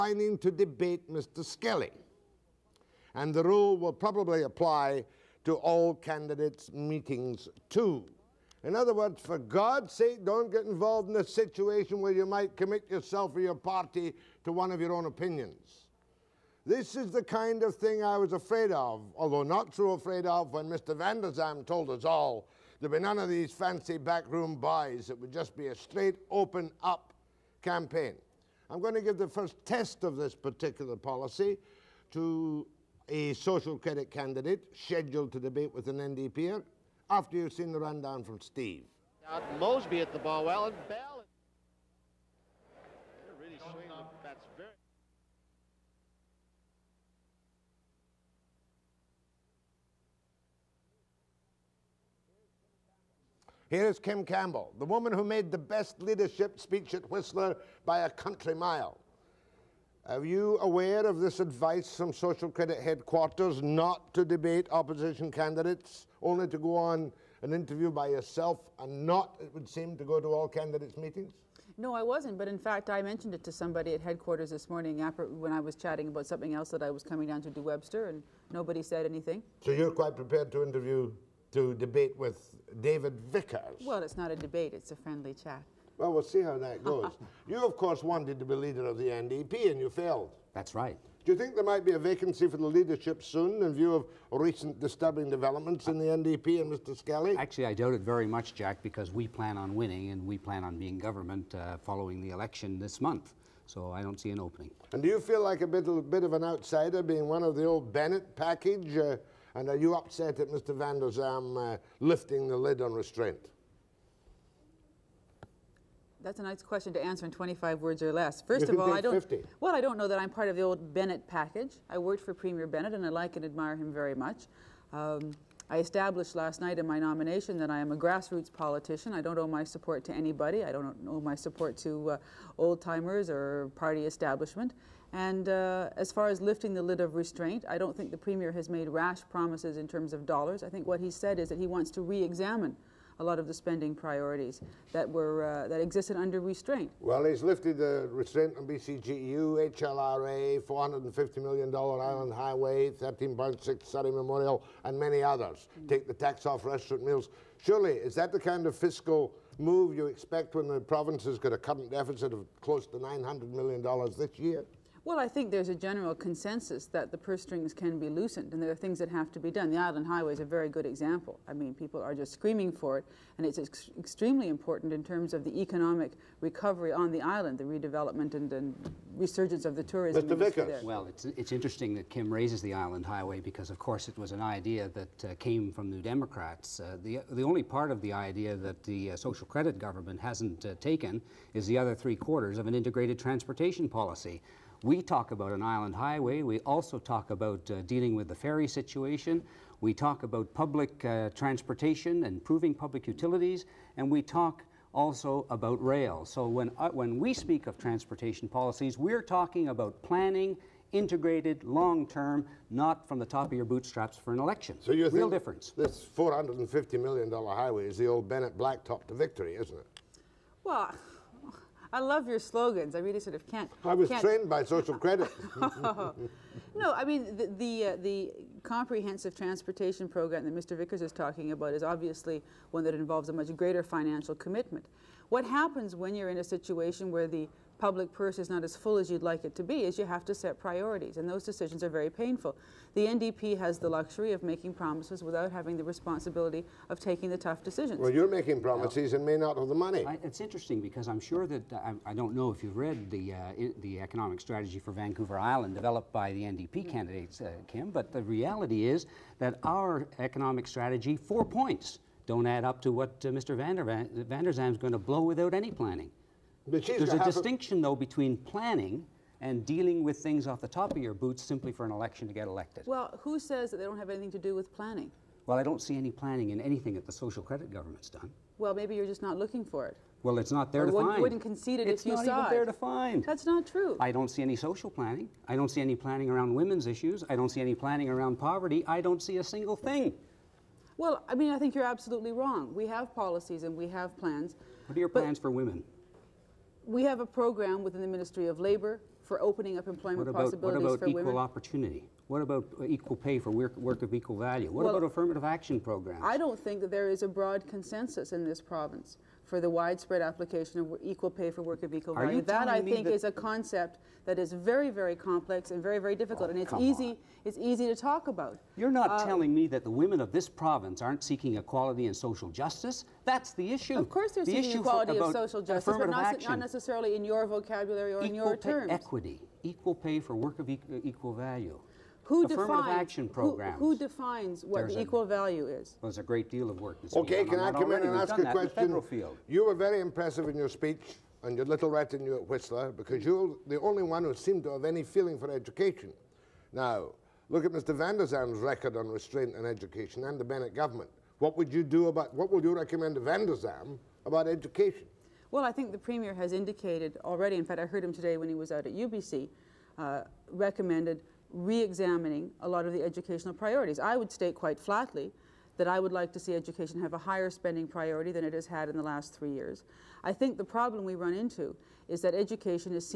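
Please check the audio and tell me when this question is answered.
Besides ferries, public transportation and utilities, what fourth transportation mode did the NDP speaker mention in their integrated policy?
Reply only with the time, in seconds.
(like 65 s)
205 s.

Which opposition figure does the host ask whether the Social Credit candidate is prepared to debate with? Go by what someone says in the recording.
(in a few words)
David Vickers.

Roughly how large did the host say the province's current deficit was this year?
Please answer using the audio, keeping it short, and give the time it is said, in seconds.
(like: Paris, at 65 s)
$900 million, at 162 s.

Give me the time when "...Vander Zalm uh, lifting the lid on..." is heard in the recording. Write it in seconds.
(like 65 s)
110 s.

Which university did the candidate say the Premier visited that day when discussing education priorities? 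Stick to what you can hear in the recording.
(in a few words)
UBC.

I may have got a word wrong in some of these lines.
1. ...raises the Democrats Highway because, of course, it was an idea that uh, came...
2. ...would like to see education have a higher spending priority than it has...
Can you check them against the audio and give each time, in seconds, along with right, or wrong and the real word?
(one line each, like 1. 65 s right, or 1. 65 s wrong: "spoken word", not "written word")
1. 182 s wrong: "Island", not "Democrats"
2. 365 s right.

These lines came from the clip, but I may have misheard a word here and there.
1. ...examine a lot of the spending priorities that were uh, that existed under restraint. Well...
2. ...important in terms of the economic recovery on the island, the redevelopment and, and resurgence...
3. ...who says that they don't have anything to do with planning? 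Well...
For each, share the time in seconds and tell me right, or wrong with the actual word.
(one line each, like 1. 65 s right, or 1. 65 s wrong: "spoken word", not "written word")
1. 142 s right
2. 174 s right
3. 273 s right.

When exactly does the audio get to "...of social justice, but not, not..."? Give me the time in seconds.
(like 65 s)
325 s.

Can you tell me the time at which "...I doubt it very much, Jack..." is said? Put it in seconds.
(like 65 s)
97 s.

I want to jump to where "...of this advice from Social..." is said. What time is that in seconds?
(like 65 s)
61 s.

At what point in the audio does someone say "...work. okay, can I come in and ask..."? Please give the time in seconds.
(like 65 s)
336 s.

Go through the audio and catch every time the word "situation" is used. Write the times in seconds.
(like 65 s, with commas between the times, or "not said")
11 s, 198 s, 236 s.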